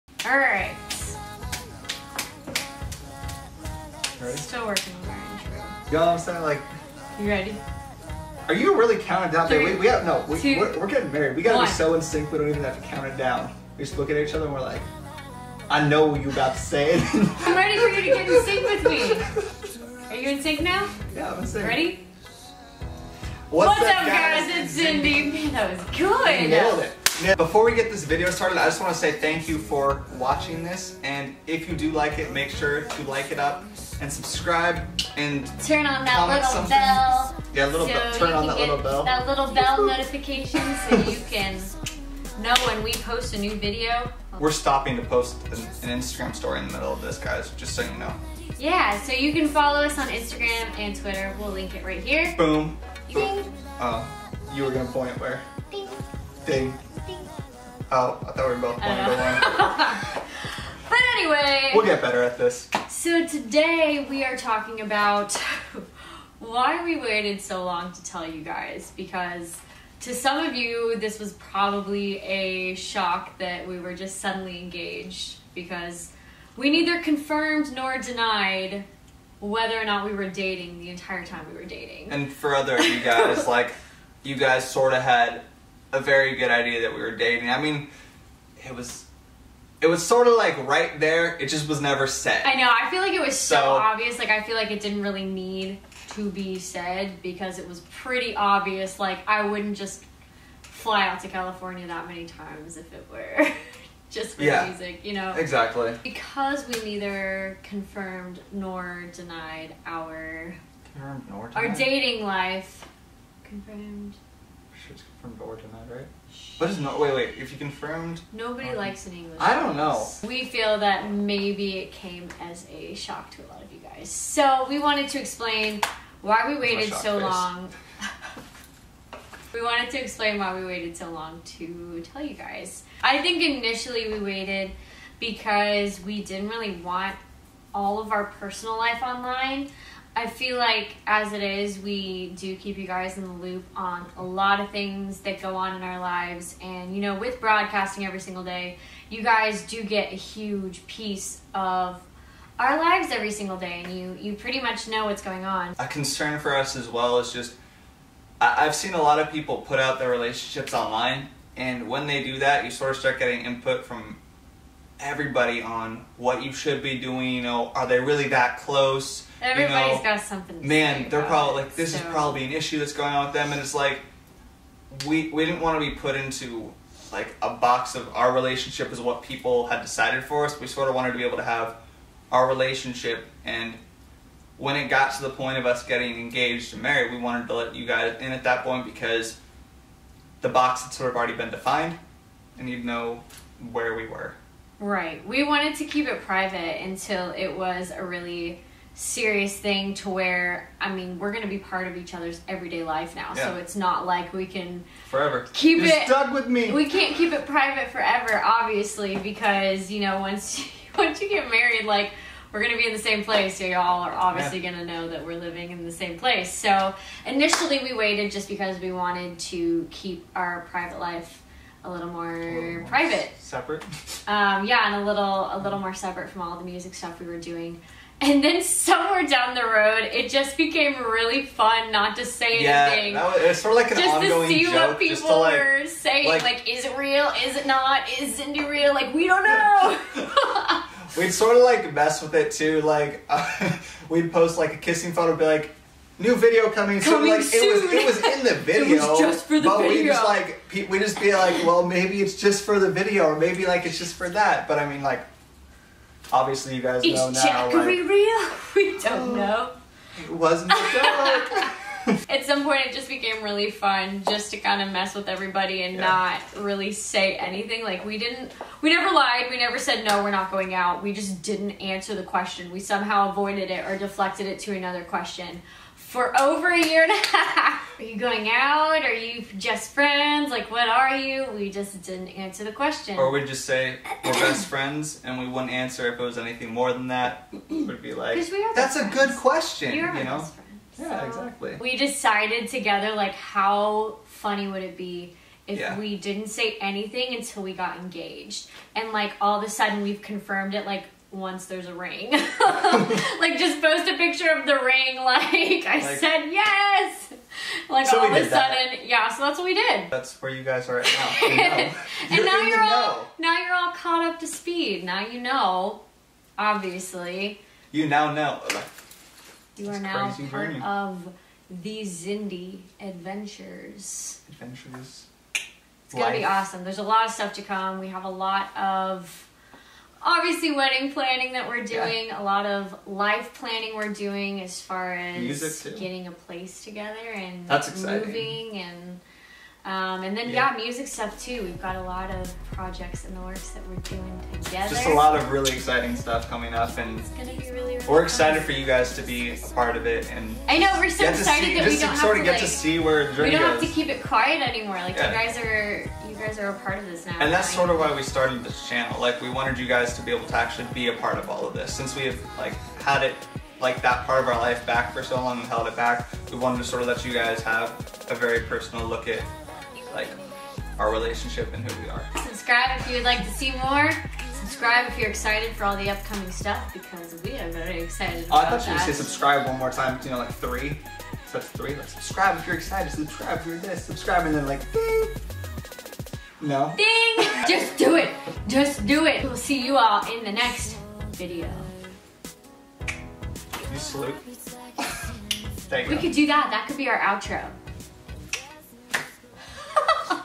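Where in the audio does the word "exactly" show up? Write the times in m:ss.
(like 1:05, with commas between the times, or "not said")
1:45, 4:51.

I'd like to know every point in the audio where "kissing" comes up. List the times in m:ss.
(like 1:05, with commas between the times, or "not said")
4:04.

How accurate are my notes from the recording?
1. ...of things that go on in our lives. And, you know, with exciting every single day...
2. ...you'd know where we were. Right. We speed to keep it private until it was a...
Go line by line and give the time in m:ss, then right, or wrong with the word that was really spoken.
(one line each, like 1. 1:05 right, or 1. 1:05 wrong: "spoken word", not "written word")
1. 2:24 wrong: "broadcasting", not "exciting"
2. 3:12 wrong: "wanted", not "speed".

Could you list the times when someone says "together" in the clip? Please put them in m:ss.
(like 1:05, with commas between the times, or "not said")
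4:52, 5:36, 5:44.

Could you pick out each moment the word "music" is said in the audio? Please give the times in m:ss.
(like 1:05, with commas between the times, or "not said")
1:44, 3:46, 5:40.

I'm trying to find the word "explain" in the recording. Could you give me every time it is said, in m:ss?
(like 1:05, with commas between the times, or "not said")
2:05, 2:10.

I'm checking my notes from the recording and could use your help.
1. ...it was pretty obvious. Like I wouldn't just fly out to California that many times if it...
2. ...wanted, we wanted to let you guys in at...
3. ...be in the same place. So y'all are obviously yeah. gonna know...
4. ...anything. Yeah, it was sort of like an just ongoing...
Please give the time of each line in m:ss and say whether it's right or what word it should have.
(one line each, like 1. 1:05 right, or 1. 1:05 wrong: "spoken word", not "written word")
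1. 1:37 right
2. 3:06 wrong: "married", not "wanted"
3. 3:32 right
4. 3:52 right.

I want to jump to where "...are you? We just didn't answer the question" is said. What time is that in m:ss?
4:40.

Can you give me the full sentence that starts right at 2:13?
I think initially we waited because we didn't really want all of our personal life online.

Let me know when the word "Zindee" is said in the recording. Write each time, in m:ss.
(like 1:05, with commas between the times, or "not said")
0:24, 3:58, 5:22.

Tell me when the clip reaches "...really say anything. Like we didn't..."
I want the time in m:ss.
4:26.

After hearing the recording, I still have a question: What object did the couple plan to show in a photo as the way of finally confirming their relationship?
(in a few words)
the ring.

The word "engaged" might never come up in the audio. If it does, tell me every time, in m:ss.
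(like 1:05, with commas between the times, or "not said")
1:14, 3:06, 4:57.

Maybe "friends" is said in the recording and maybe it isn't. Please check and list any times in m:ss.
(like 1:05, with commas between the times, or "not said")
4:39, 4:44, 4:48.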